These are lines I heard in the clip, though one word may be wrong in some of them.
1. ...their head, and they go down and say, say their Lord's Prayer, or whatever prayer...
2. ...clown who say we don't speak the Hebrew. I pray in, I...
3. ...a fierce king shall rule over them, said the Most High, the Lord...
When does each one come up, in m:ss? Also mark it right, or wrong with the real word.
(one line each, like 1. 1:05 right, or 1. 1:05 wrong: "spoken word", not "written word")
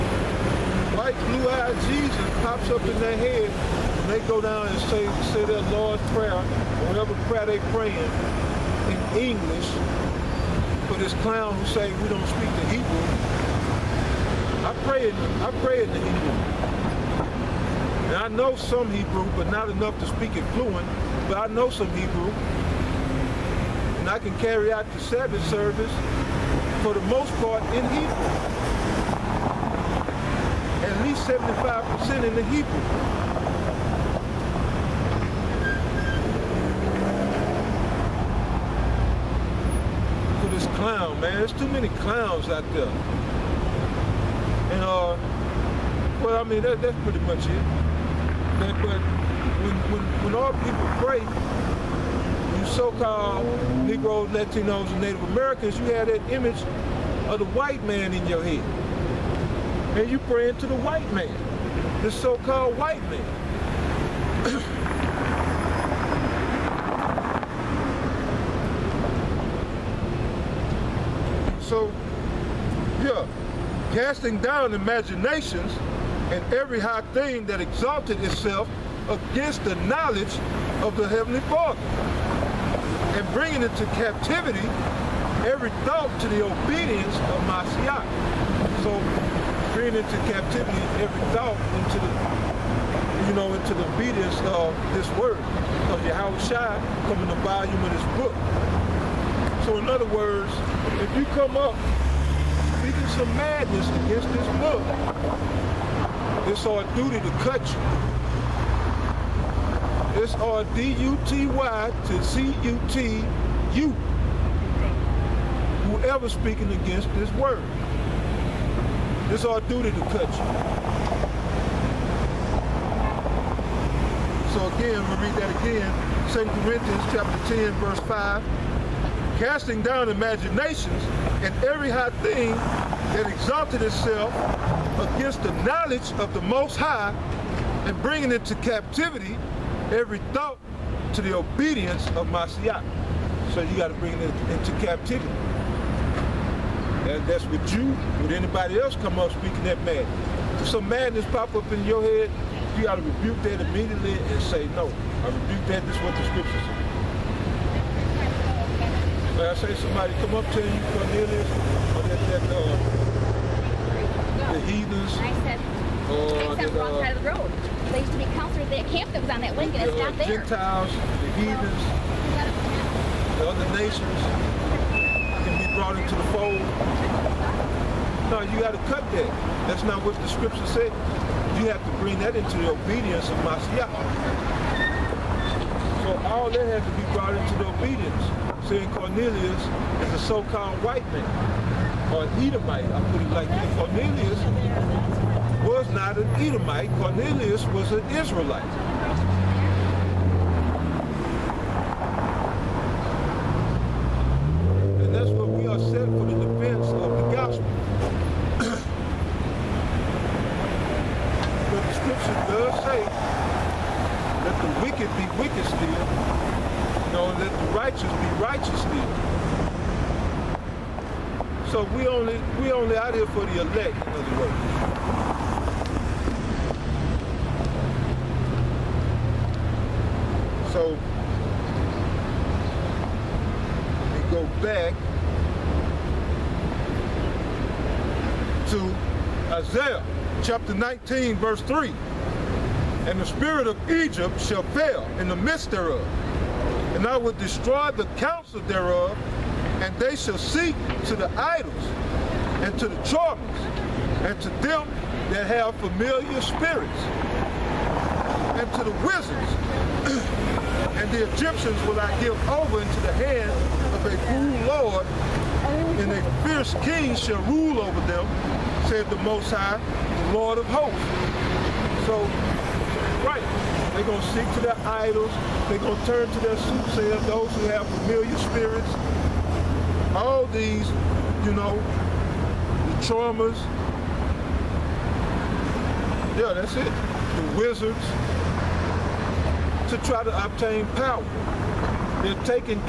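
1. 0:02 right
2. 0:11 right
3. 4:26 right.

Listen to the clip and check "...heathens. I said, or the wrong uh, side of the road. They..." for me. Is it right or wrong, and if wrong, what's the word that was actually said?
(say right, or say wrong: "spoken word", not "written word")
right.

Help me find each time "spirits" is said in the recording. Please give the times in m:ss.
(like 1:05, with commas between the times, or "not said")
4:03, 4:16, 4:38.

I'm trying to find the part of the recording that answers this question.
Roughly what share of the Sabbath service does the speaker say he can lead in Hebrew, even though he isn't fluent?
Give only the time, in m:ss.
0:31.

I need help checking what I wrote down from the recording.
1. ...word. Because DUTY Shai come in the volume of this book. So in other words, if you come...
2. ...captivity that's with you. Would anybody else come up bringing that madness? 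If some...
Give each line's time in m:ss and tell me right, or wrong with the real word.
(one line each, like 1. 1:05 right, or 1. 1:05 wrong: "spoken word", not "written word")
1. 1:35 wrong: "Yahweh", not "DUTY"
2. 2:24 wrong: "speaking", not "bringing".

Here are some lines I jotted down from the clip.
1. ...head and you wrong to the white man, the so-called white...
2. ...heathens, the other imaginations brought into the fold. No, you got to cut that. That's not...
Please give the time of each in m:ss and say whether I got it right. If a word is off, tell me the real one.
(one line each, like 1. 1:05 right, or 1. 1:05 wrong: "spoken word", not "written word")
1. 0:58 wrong: "praying", not "wrong"
2. 2:51 wrong: "nations", not "imaginations".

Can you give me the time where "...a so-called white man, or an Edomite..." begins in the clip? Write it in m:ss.
3:10.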